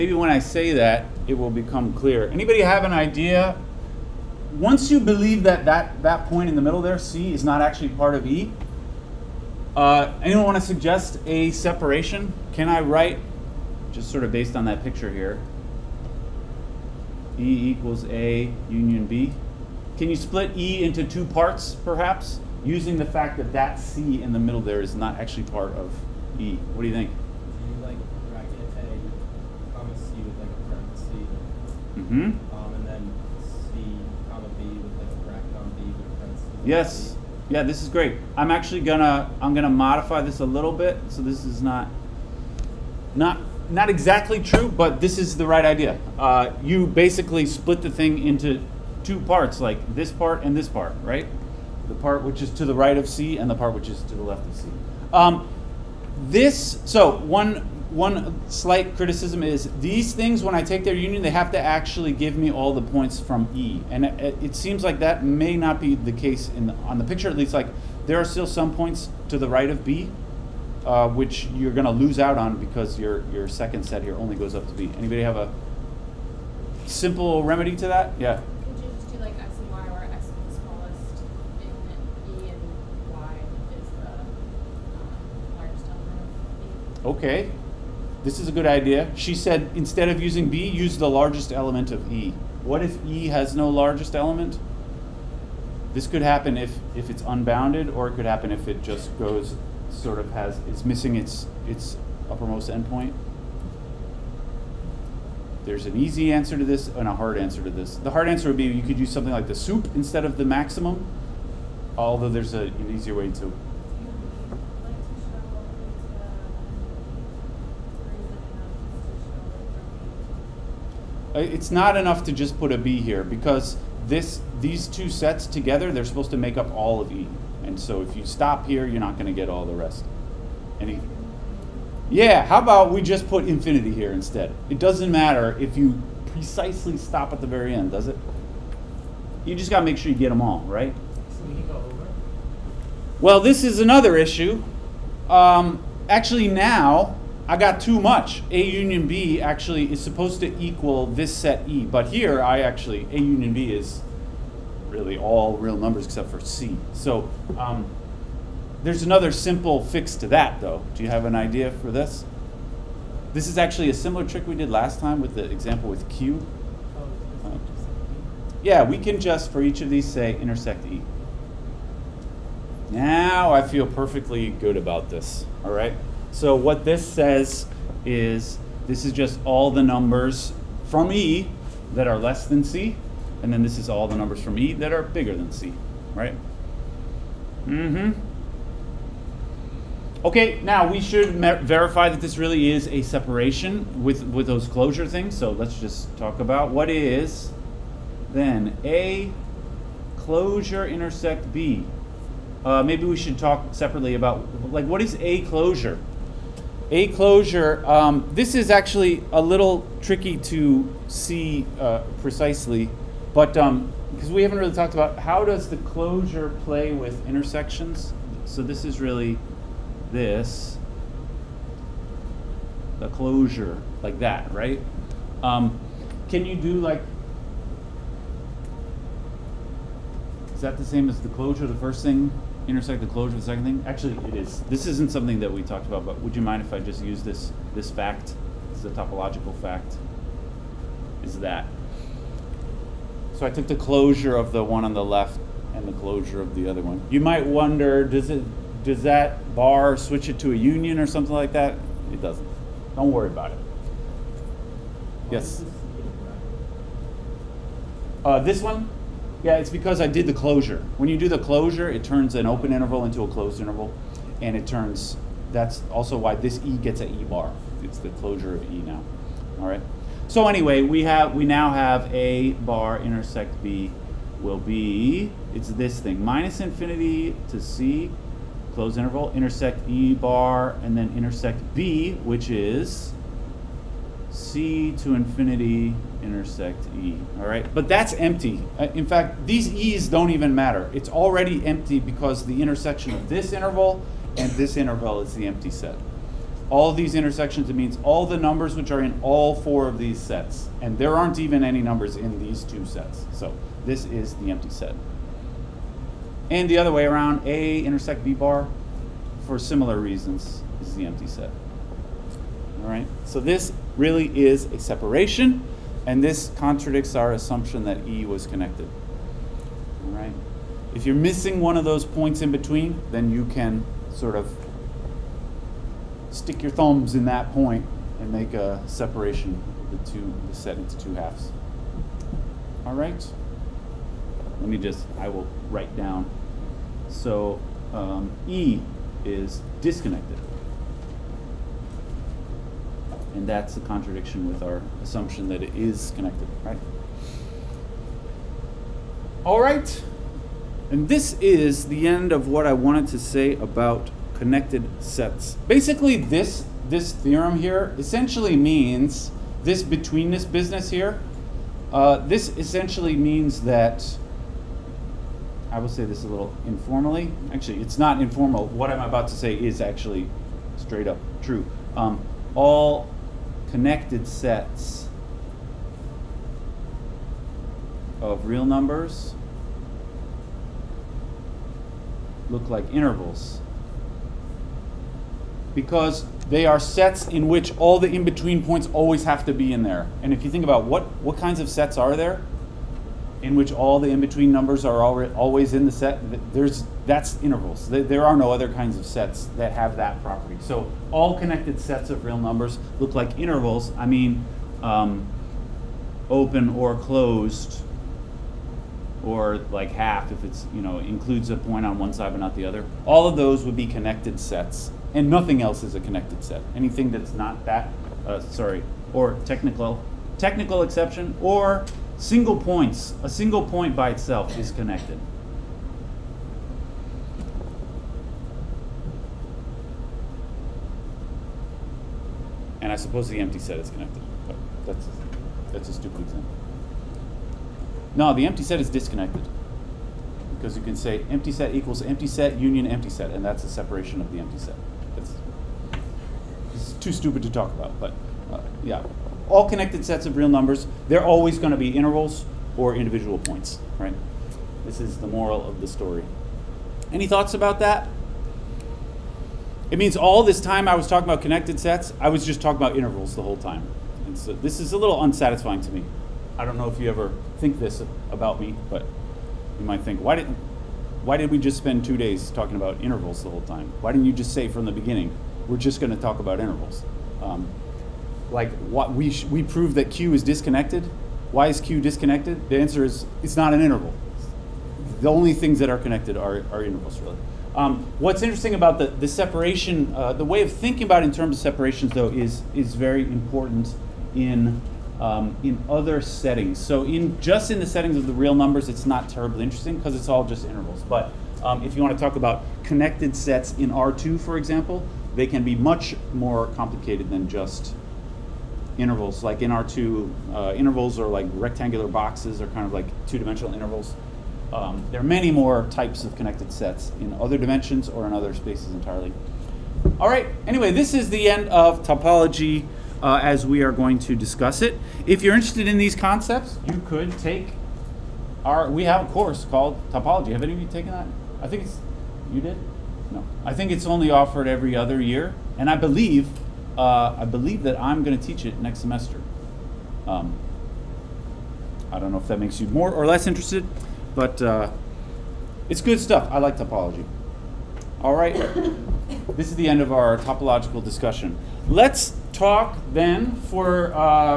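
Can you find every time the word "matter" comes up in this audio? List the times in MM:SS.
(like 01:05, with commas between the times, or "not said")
02:15, 04:50.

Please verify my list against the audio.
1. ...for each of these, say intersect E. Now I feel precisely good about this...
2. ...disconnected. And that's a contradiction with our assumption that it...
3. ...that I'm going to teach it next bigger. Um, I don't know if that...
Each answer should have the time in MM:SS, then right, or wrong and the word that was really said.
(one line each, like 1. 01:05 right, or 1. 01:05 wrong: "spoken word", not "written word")
1. 02:49 wrong: "perfectly", not "precisely"
2. 05:39 right
3. 08:57 wrong: "semester", not "bigger".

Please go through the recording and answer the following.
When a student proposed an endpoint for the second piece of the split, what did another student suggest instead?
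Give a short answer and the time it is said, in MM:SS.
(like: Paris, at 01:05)
the largest element of E, at 01:30.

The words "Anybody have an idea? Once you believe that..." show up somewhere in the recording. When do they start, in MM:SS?
00:02.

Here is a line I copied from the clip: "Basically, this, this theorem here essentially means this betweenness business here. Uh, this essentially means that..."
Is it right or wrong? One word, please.
right.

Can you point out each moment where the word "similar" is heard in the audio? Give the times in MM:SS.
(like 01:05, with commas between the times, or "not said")
02:43, 05:09.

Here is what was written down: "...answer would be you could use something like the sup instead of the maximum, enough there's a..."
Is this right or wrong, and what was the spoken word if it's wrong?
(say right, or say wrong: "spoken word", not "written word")
wrong: "although", not "enough".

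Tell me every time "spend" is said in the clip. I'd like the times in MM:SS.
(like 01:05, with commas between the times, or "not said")
07:51.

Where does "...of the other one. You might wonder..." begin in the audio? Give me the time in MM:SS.
04:06.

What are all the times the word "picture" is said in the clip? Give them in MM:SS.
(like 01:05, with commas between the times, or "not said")
00:14, 01:07.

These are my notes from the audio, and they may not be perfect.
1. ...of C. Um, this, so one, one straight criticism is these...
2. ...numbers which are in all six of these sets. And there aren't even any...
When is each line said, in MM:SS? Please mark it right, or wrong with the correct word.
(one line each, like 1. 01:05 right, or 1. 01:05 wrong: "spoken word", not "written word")
1. 00:54 wrong: "slight", not "straight"
2. 04:58 wrong: "four", not "six".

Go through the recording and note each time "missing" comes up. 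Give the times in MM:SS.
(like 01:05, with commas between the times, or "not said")
01:40, 05:21.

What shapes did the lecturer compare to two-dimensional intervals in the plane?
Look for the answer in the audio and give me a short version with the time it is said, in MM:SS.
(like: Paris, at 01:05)
rectangular boxes, at 08:31.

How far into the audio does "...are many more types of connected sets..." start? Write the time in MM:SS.
08:35.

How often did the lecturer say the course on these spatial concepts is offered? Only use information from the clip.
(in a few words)
every other year.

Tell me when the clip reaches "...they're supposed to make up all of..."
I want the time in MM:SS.
02:05.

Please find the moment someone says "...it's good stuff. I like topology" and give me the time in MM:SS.
09:05.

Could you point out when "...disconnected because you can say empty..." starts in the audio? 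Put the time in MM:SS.
07:18.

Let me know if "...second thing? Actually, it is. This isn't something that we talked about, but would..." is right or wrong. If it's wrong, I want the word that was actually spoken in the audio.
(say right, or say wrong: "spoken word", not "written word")
right.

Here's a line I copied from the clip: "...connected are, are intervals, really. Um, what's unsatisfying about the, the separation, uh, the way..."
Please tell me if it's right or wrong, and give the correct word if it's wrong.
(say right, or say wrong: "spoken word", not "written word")
wrong: "interesting", not "unsatisfying".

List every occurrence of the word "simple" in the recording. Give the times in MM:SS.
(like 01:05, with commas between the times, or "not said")
01:16, 02:39.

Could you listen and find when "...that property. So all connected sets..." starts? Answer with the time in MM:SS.
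06:39.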